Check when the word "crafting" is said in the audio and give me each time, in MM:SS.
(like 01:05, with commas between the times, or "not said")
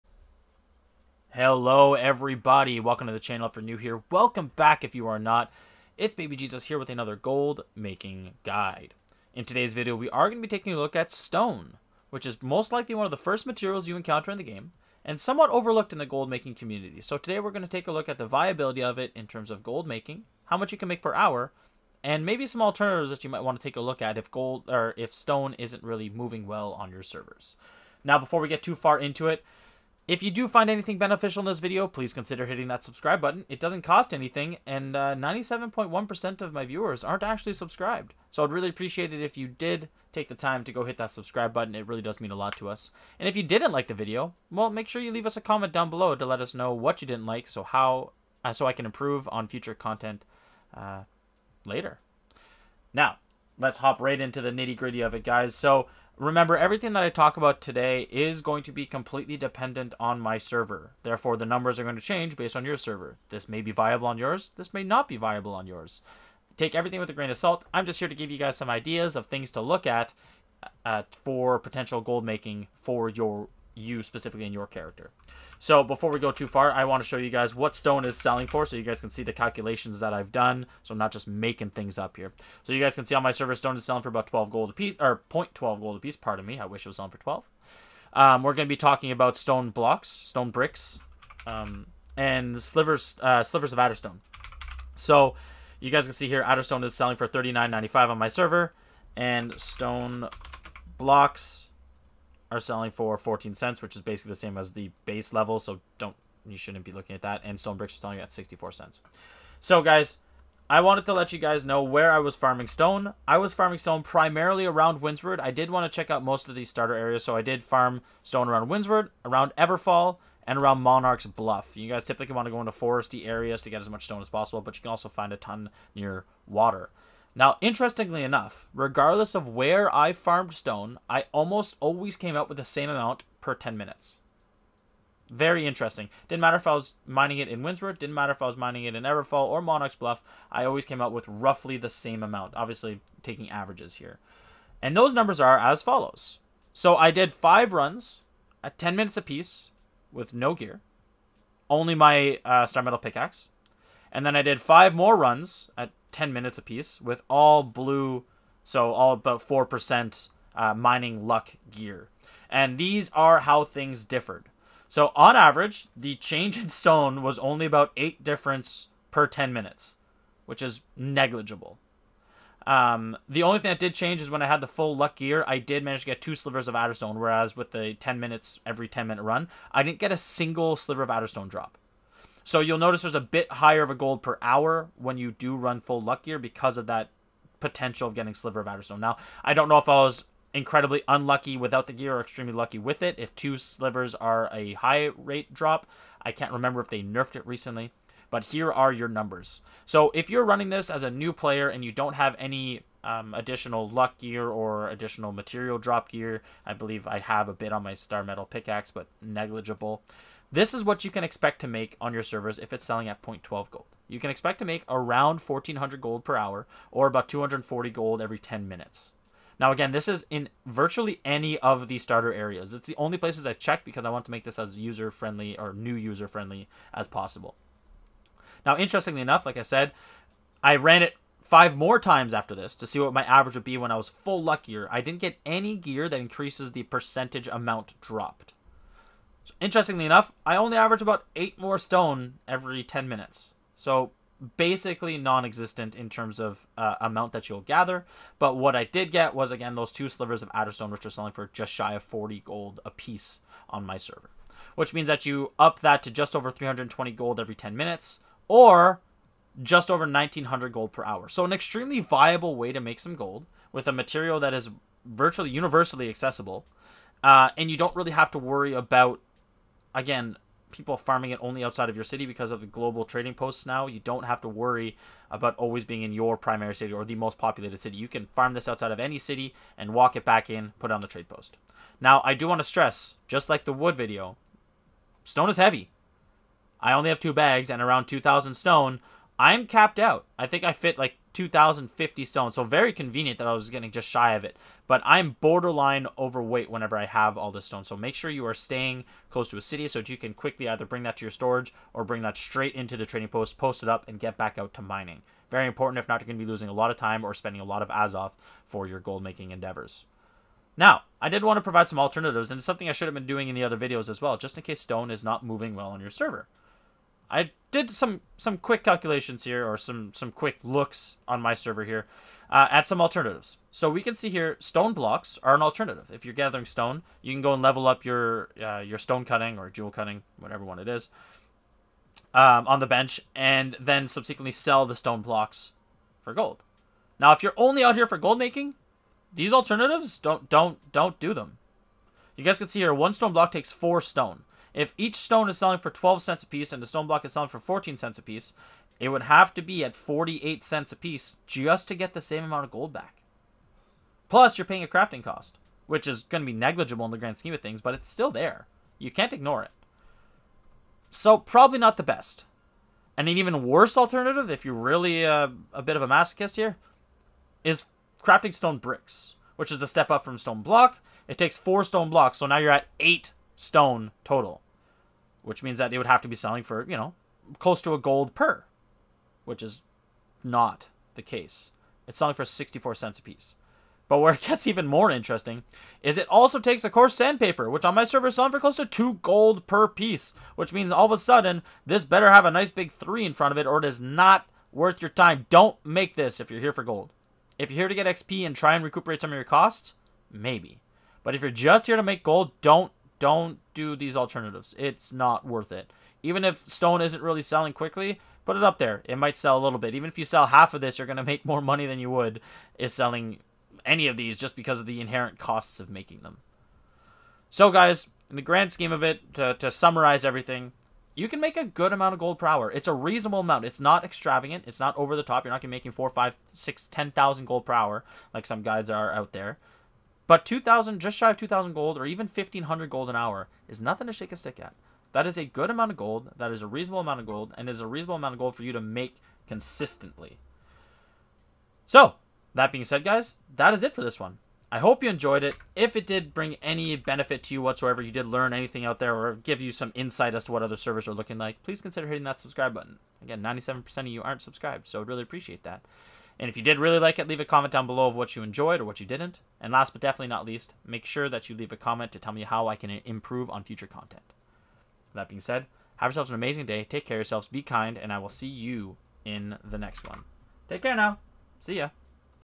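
05:54, 06:08.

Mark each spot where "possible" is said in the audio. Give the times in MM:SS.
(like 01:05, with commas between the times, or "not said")
02:04, 03:47.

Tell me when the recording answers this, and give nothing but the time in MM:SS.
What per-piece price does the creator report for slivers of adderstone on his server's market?
01:37.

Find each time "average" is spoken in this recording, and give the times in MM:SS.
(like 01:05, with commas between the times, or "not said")
02:23, 02:45, 03:53, 04:00.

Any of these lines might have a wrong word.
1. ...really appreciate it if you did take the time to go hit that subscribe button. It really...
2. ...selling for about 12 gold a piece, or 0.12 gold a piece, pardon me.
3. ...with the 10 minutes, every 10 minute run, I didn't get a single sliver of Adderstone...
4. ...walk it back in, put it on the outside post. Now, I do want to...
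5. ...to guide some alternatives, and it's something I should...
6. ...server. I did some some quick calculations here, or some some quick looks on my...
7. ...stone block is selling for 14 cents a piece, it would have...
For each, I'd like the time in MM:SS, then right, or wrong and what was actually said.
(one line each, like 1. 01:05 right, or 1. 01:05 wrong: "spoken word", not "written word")
1. 00:38 right
2. 01:23 right
3. 02:57 right
4. 04:39 wrong: "trade", not "outside"
5. 05:11 wrong: "provide", not "guide"
6. 05:16 right
7. 05:46 right.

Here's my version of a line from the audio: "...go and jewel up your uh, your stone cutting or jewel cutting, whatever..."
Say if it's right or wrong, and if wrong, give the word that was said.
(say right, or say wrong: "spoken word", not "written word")
wrong: "level", not "jewel".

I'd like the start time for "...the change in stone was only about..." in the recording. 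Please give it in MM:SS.
02:45.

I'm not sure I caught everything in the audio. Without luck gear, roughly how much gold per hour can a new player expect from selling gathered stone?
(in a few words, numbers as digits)
1400 gold.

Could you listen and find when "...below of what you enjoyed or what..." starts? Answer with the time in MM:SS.
07:37.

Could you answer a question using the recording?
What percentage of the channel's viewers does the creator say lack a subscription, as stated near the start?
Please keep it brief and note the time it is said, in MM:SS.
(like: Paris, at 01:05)
97.1%, at 00:34.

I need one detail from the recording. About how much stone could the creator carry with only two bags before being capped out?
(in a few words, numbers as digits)
2,050.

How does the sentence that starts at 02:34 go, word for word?
And then I did five more runs at 10 minutes apiece with all blue, so all about 4% uh, mining luck gear.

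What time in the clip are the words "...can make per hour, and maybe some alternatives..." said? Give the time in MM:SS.
00:20.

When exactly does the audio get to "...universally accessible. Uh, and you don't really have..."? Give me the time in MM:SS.
04:25.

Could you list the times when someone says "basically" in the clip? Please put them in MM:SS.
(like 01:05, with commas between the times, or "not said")
01:44, 04:04.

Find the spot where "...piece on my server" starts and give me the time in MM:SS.
04:12.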